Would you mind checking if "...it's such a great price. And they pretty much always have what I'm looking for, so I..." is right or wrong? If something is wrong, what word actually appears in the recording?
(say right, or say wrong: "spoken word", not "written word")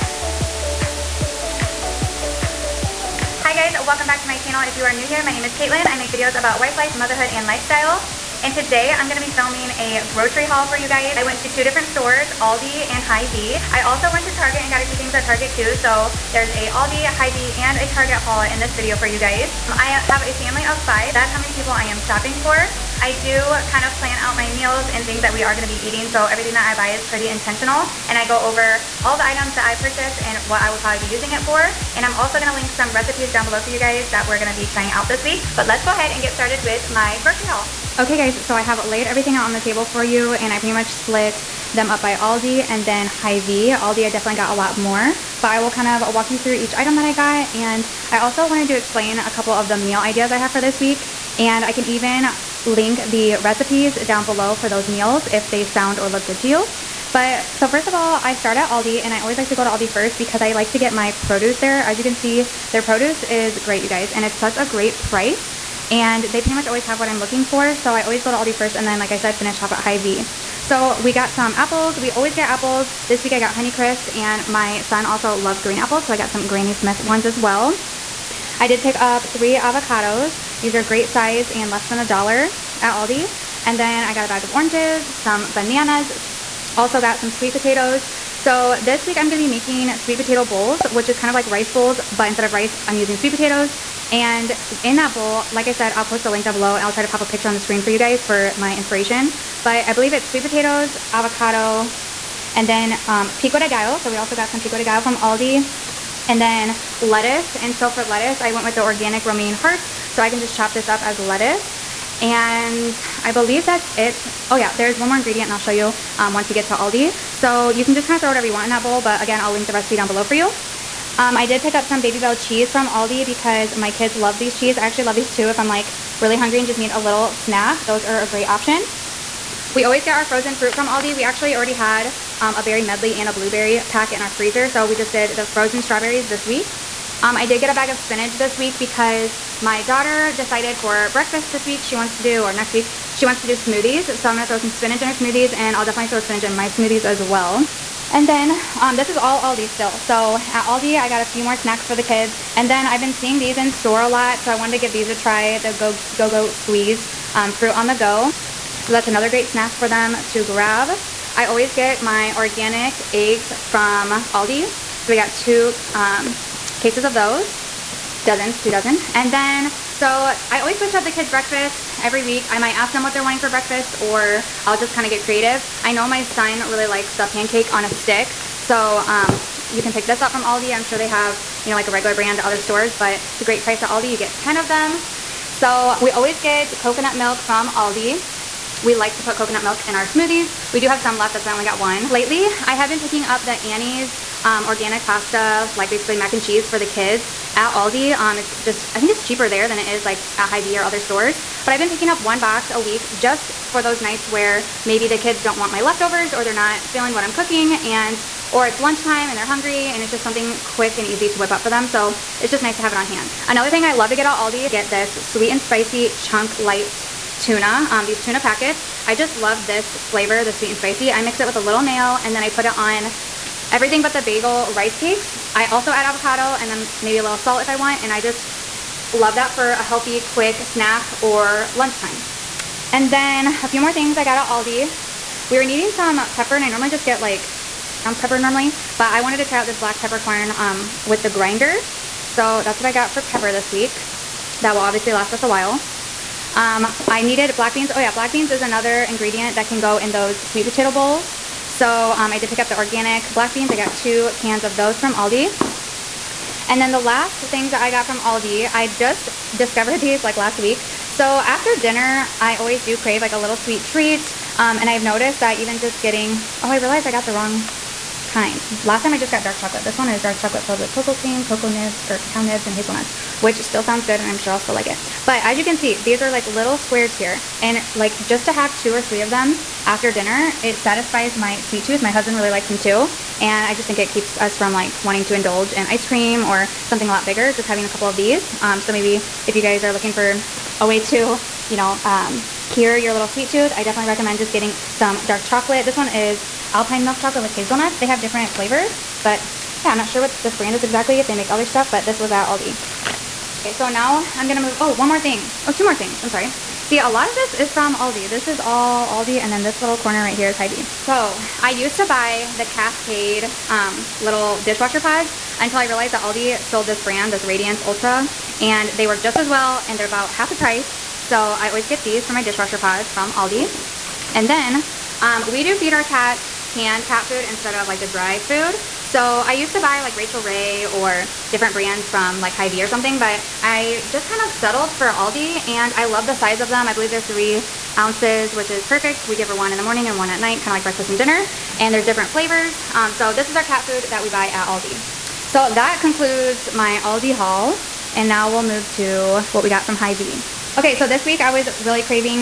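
right.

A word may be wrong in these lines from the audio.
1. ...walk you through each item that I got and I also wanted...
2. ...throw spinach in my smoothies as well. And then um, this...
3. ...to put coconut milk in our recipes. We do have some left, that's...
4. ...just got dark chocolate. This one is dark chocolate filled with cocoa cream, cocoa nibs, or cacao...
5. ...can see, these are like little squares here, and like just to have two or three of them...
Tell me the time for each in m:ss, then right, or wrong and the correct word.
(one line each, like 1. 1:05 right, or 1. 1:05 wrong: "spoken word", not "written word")
1. 0:46 right
2. 2:26 right
3. 3:09 wrong: "smoothies", not "recipes"
4. 4:29 right
5. 4:35 right.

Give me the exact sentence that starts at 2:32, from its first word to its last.
And then I've been seeing these in store a lot.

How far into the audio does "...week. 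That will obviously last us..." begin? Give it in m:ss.
4:03.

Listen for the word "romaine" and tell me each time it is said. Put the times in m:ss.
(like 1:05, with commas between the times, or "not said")
1:49.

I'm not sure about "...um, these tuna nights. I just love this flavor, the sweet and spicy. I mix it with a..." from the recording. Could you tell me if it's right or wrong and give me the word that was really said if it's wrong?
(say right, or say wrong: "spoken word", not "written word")
wrong: "packets", not "nights".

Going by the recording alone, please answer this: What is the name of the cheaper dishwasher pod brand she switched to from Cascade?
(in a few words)
Radiance Ultra.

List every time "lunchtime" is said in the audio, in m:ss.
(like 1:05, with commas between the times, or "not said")
3:28, 3:51.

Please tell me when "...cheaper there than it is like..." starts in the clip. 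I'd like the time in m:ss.
3:19.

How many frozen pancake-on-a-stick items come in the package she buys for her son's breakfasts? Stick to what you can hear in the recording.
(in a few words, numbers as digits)
10.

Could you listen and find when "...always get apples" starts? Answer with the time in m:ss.
1:12.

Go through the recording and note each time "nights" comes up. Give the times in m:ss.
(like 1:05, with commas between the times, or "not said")
3:24, 5:40.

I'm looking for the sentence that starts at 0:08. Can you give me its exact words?
And today I'm gonna be filming a grocery haul for you guys.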